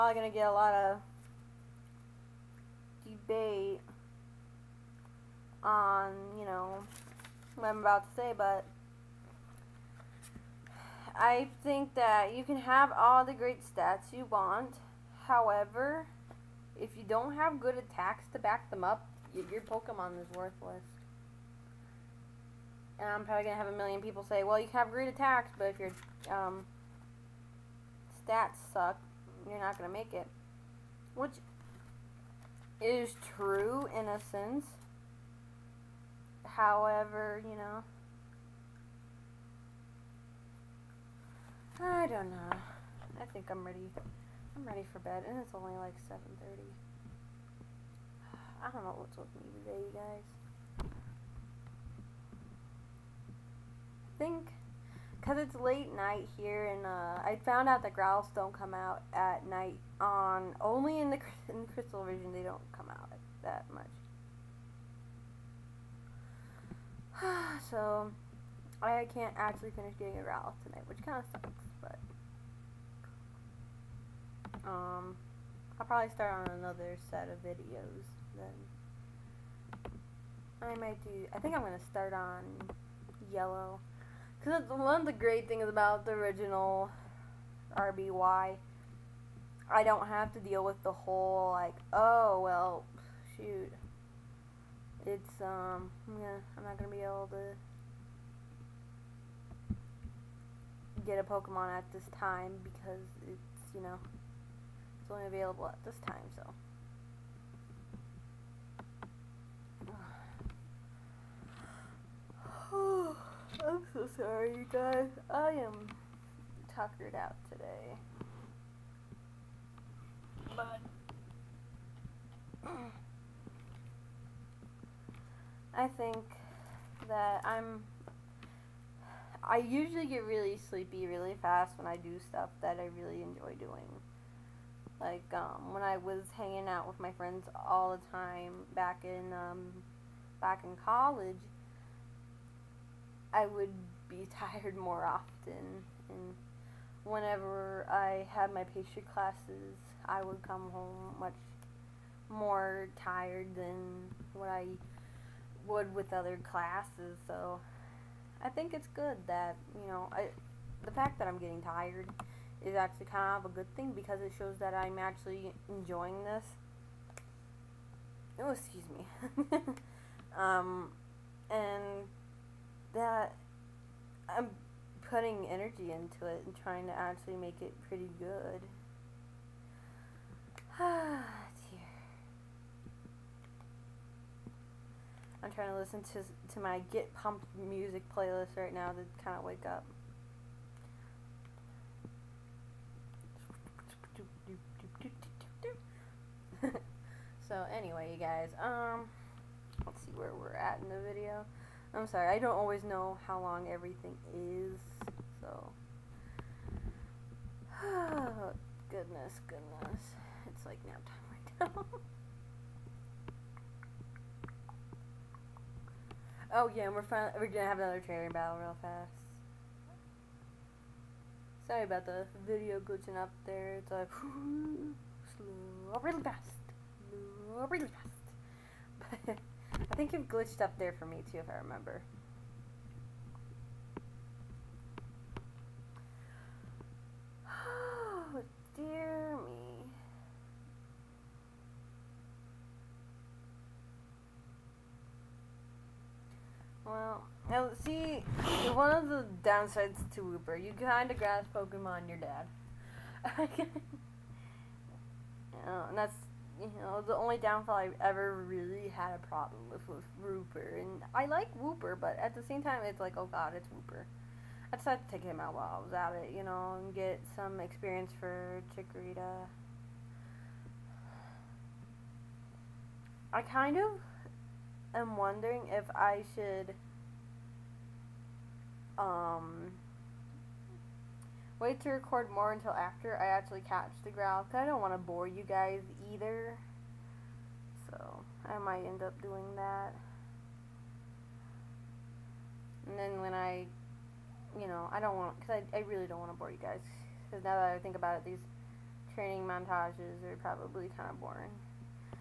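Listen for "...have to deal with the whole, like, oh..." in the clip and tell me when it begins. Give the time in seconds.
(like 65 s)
90 s.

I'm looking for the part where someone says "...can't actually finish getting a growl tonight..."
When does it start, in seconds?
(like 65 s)
69 s.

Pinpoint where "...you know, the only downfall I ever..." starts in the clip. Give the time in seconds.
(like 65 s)
256 s.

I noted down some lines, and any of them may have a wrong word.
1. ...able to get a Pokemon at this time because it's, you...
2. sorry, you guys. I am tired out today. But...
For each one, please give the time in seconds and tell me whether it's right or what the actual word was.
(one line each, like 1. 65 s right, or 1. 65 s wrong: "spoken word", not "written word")
1. 97 s right
2. 114 s wrong: "tuckered", not "tired".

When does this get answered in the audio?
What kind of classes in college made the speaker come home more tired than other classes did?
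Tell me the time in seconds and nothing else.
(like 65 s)
148 s.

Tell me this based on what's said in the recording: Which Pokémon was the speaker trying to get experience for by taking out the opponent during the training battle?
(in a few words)
Chikorita.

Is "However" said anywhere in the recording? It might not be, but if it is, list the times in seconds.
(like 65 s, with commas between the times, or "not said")
15 s, 36 s.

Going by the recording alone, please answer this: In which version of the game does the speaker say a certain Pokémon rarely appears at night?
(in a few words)
Crystal.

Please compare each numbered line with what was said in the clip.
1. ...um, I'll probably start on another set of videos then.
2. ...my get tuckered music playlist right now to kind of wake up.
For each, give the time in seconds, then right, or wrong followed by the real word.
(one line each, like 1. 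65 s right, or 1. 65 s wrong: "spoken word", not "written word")
1. 74 s right
2. 186 s wrong: "pumped", not "tuckered".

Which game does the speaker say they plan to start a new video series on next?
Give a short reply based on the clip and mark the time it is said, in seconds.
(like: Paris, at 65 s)
Yellow, at 83 s.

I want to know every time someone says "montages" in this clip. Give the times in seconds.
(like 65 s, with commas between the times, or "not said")
299 s.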